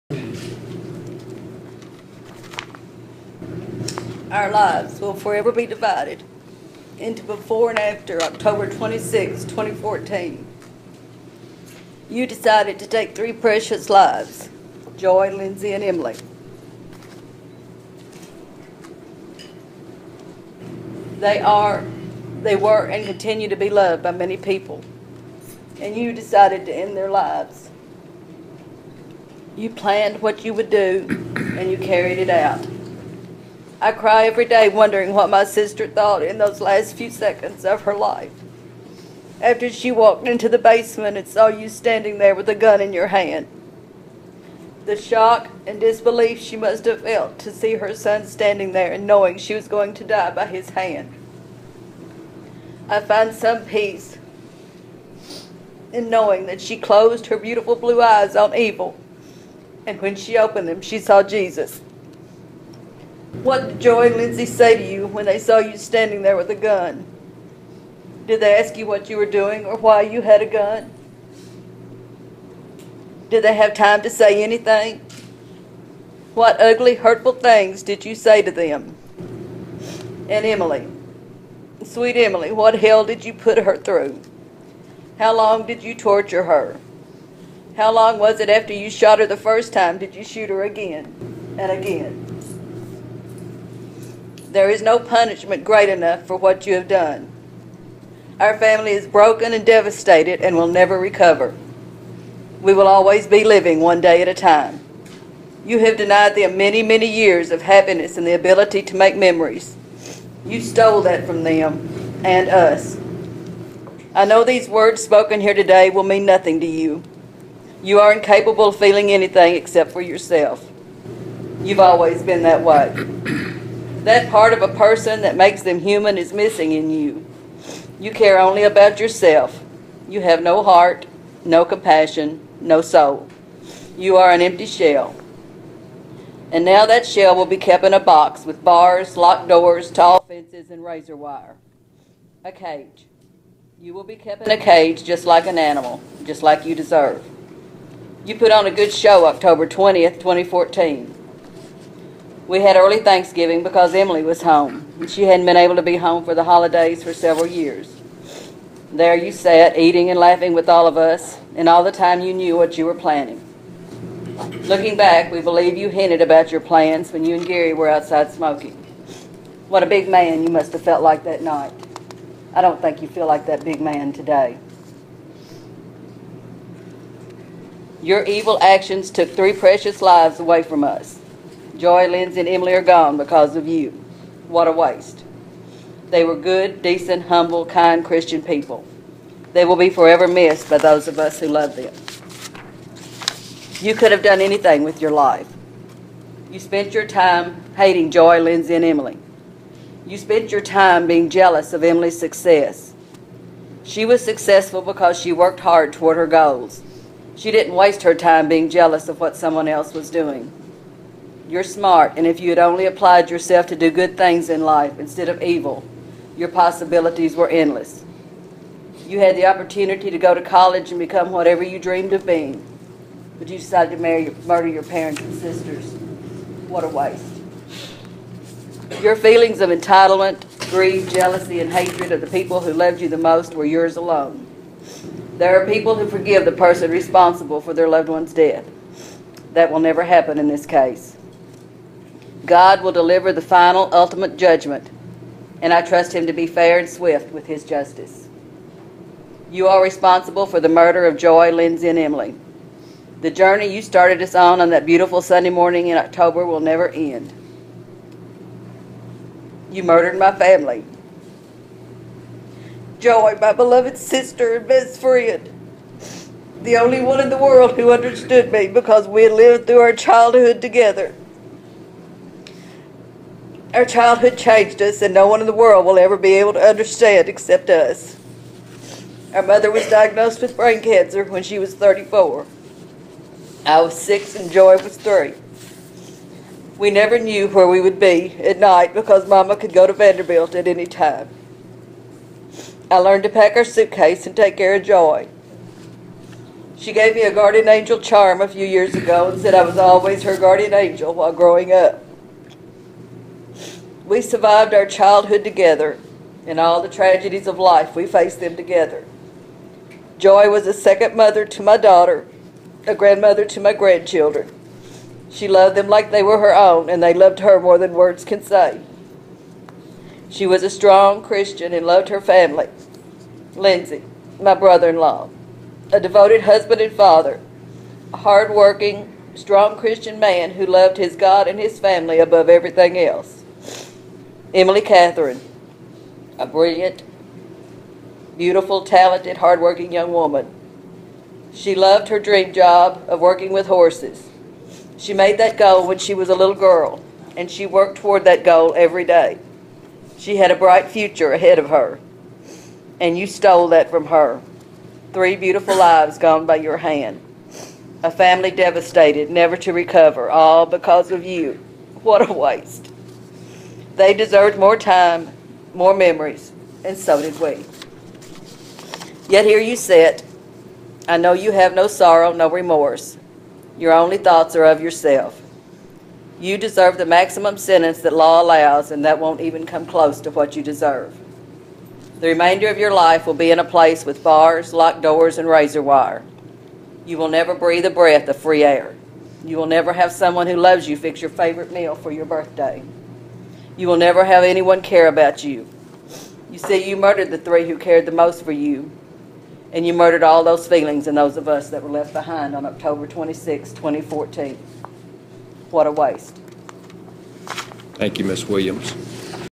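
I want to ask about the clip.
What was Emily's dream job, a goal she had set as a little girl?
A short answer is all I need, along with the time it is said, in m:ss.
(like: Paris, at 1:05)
Working with horses, at 5:43.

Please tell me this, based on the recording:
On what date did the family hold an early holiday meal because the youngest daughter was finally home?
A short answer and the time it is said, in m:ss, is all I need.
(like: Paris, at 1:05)
October 20, 2014, at 2:29.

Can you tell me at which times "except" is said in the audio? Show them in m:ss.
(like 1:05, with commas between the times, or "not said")
1:59, 4:37.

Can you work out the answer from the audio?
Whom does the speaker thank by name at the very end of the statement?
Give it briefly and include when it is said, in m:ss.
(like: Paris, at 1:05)
Ms. Williams, at 6:48.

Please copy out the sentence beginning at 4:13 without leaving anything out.
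The journey you started us on on that beautiful Sunday morning in October will never end.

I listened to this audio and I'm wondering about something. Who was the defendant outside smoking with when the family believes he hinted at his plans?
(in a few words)
Gary.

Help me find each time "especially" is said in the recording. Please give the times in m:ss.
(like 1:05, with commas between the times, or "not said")
not said.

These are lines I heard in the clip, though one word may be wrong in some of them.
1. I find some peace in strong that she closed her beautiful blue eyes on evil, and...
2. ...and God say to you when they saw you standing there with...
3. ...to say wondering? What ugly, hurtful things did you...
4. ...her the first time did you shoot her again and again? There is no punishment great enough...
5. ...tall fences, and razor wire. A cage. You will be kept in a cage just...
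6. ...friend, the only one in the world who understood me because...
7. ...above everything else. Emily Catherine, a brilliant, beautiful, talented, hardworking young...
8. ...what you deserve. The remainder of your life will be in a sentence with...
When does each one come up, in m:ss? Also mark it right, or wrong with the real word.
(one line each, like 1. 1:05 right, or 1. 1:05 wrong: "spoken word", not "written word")
1. 0:52 wrong: "knowing", not "strong"
2. 1:04 wrong: "Lindsay", not "God"
3. 1:14 wrong: "anything", not "wondering"
4. 1:29 right
5. 2:19 right
6. 4:24 right
7. 5:32 right
8. 6:20 wrong: "place", not "sentence".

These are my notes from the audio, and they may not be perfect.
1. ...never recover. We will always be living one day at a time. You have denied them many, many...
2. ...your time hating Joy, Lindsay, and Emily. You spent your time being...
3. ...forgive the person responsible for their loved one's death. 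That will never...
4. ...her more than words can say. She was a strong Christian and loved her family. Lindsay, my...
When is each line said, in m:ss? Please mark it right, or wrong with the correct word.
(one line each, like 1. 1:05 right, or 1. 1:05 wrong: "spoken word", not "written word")
1. 1:40 right
2. 3:16 right
3. 3:56 right
4. 5:17 right.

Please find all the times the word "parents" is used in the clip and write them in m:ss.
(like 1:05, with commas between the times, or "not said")
3:44.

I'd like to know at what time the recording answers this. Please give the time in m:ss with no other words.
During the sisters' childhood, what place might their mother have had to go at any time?
4:49.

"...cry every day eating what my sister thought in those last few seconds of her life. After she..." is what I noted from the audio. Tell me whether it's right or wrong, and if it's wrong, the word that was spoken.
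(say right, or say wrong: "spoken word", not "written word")
wrong: "wondering", not "eating".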